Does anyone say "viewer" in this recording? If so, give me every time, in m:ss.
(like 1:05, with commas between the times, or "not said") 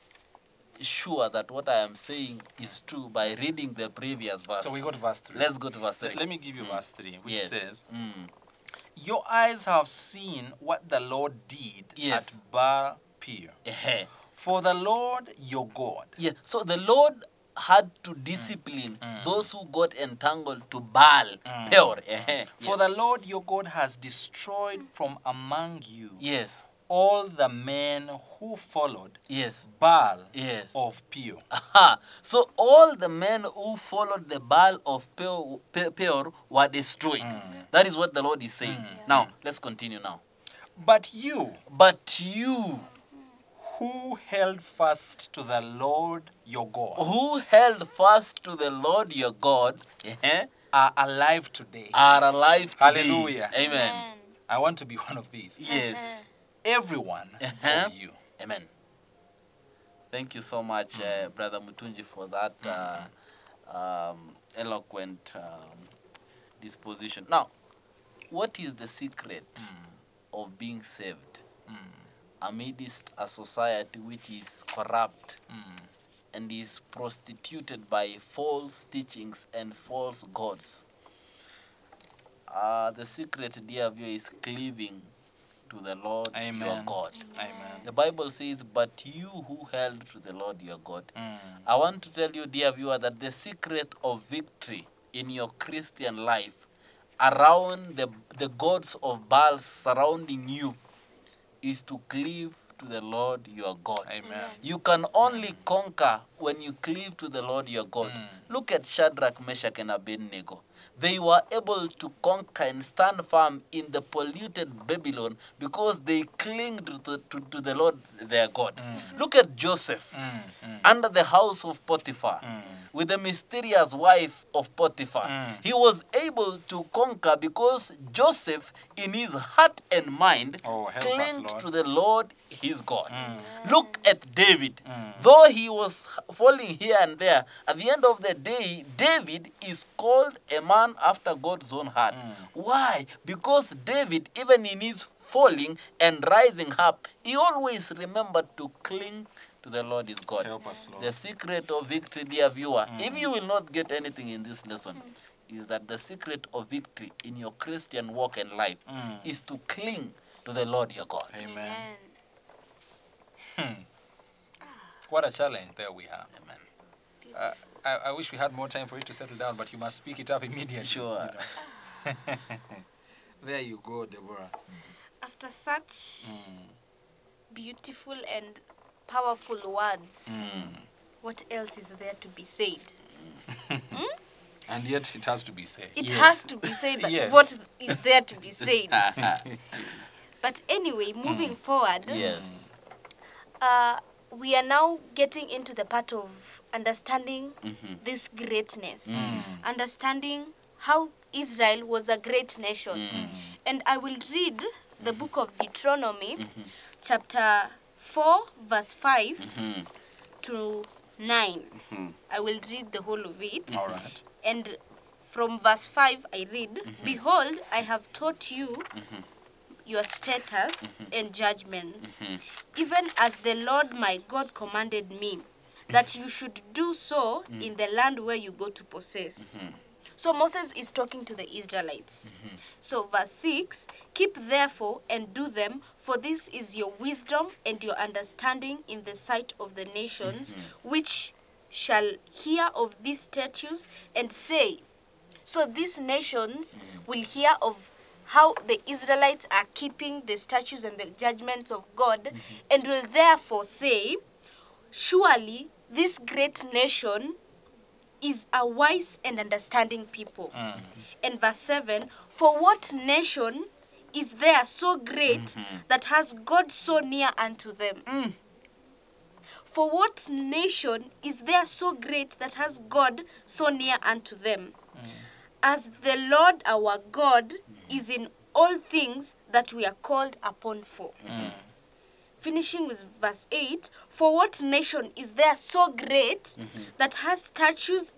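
1:23, 1:32, 2:32.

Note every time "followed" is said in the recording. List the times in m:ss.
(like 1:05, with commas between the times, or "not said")
0:28, 0:33.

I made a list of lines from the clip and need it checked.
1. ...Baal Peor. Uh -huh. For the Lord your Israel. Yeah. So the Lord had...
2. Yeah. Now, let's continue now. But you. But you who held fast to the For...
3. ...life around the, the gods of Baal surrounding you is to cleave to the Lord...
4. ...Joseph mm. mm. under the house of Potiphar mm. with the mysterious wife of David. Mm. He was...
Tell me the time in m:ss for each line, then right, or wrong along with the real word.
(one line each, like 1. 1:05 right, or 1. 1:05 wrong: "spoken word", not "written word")
1. 0:12 wrong: "God", not "Israel"
2. 0:38 wrong: "Lord", not "For"
3. 1:36 right
4. 1:59 wrong: "Potiphar", not "David".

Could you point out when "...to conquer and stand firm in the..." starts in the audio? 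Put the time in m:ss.
1:51.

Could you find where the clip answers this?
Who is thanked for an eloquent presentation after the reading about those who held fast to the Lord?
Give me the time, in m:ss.
1:01.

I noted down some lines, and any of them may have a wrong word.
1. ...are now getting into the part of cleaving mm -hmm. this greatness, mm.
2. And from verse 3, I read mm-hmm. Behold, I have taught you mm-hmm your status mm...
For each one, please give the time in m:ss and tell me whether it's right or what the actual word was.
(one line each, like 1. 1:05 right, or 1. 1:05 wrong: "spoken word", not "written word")
1. 3:14 wrong: "understanding", not "cleaving"
2. 3:34 wrong: "5", not "3".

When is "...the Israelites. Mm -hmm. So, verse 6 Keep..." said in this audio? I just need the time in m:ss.
3:51.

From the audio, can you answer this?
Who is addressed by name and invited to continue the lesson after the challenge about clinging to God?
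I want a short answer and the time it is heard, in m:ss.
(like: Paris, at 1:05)
Deborah, at 2:54.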